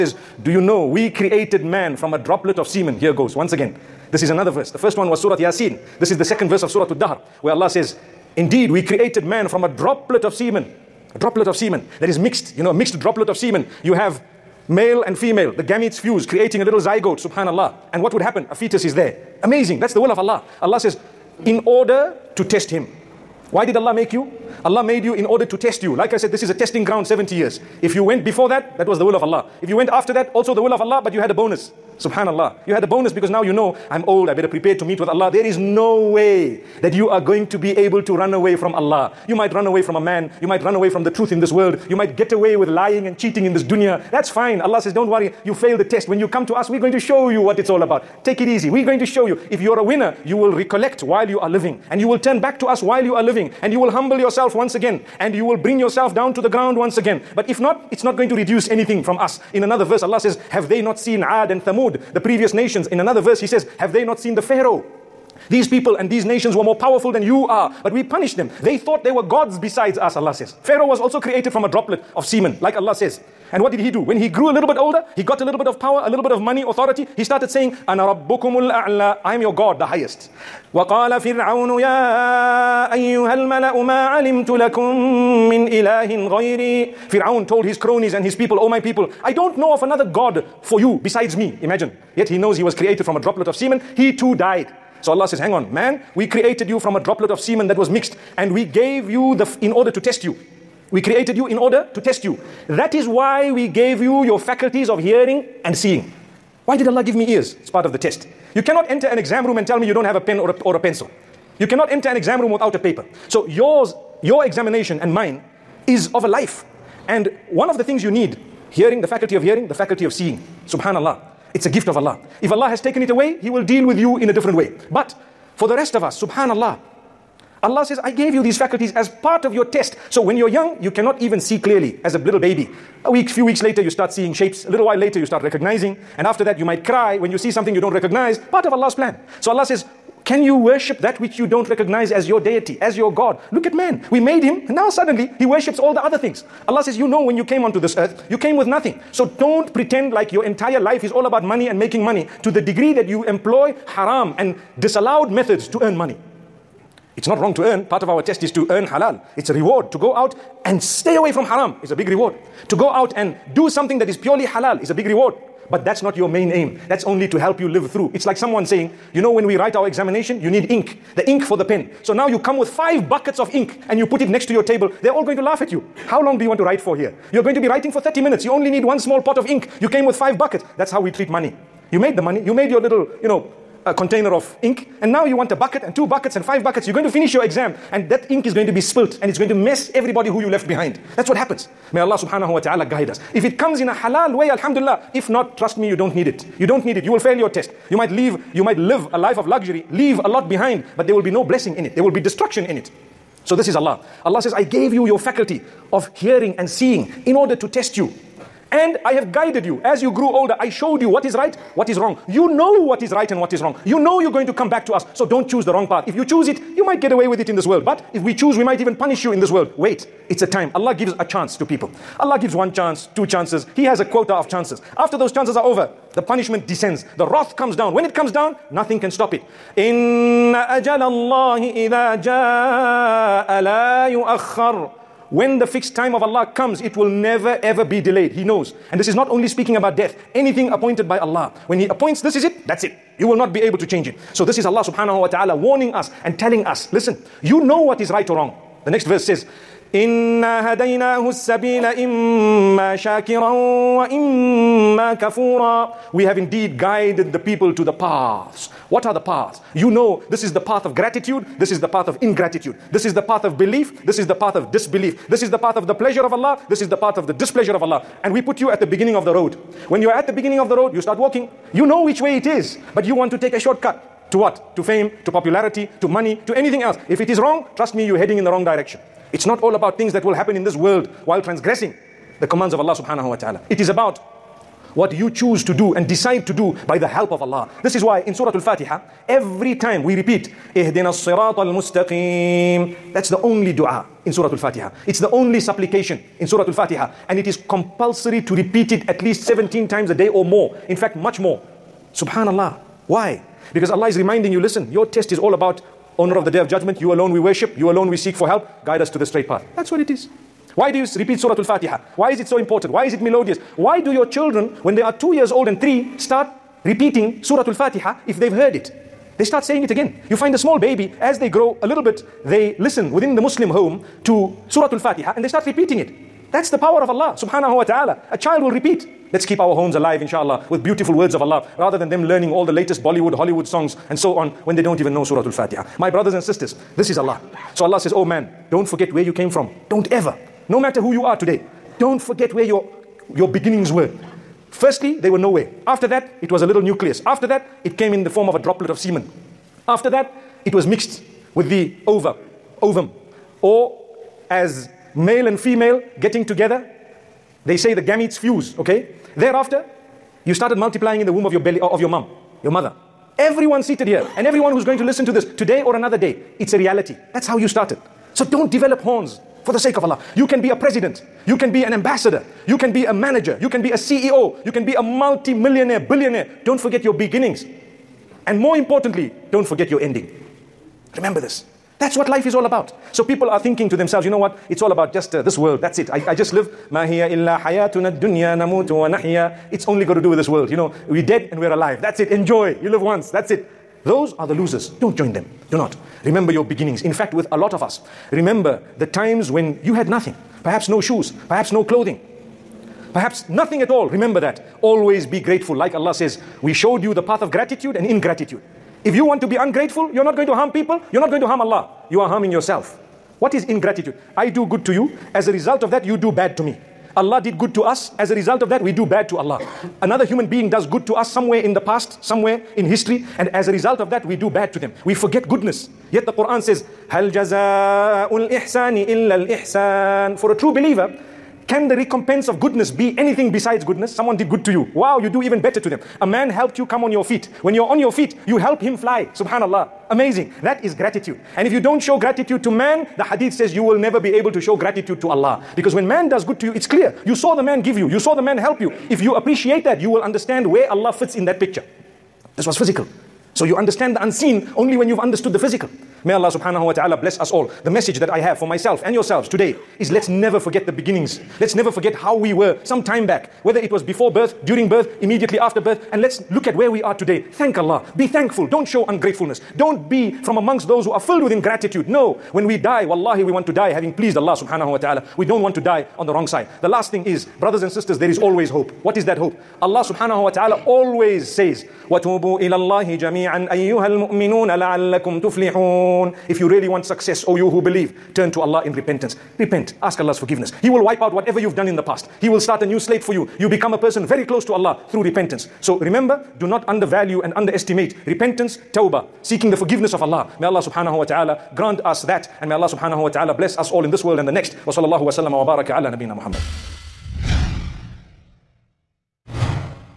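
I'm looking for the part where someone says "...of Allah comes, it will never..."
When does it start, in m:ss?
3:56.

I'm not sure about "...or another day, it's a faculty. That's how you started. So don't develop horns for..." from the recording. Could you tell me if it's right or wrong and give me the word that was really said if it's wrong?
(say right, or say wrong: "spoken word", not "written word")
wrong: "reality", not "faculty".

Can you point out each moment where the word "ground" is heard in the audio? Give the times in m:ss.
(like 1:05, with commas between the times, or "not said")
0:26, 0:56.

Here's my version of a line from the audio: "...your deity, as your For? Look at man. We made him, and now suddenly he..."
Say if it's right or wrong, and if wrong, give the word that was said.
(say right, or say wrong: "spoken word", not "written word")
wrong: "God", not "For".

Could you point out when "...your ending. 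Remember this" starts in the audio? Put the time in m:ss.
6:19.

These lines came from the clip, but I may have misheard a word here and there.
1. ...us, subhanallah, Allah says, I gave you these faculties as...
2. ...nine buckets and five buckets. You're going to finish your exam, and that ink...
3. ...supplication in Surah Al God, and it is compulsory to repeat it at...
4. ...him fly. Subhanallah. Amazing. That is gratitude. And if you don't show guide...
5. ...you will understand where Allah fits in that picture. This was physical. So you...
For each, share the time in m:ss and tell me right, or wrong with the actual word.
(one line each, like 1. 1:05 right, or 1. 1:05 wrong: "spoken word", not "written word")
1. 2:06 right
2. 3:05 wrong: "two", not "nine"
3. 4:55 wrong: "Fatiha", not "God"
4. 7:18 wrong: "gratitude", not "guide"
5. 7:29 right.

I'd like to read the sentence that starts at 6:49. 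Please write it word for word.
If you want to be ungrateful, you're not going to harm people, you're not going to harm Allah.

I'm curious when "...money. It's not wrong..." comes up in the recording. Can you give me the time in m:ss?
2:35.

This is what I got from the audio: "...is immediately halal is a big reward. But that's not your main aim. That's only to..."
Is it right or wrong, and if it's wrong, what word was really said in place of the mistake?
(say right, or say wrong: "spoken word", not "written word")
wrong: "purely", not "immediately".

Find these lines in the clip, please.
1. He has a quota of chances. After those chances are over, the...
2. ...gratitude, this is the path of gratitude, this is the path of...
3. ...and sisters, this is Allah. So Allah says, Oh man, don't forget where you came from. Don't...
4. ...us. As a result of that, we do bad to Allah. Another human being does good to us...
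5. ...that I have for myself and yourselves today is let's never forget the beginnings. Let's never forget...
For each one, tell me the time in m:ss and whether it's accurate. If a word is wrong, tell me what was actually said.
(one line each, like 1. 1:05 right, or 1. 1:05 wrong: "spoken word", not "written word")
1. 3:43 right
2. 4:20 wrong: "ingratitude", not "gratitude"
3. 5:36 right
4. 6:57 right
5. 7:38 right.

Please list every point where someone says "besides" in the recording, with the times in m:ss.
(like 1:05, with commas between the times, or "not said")
1:09, 1:31, 7:13.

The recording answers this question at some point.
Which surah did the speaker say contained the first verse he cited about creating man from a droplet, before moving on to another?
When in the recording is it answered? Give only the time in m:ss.
0:05.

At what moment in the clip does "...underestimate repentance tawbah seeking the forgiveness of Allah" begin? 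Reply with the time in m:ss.
8:17.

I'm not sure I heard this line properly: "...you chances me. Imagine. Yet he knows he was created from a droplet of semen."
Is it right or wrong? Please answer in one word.
wrong.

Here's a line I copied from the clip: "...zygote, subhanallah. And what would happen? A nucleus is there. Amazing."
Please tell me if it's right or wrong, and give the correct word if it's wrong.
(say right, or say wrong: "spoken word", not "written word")
wrong: "fetus", not "nucleus".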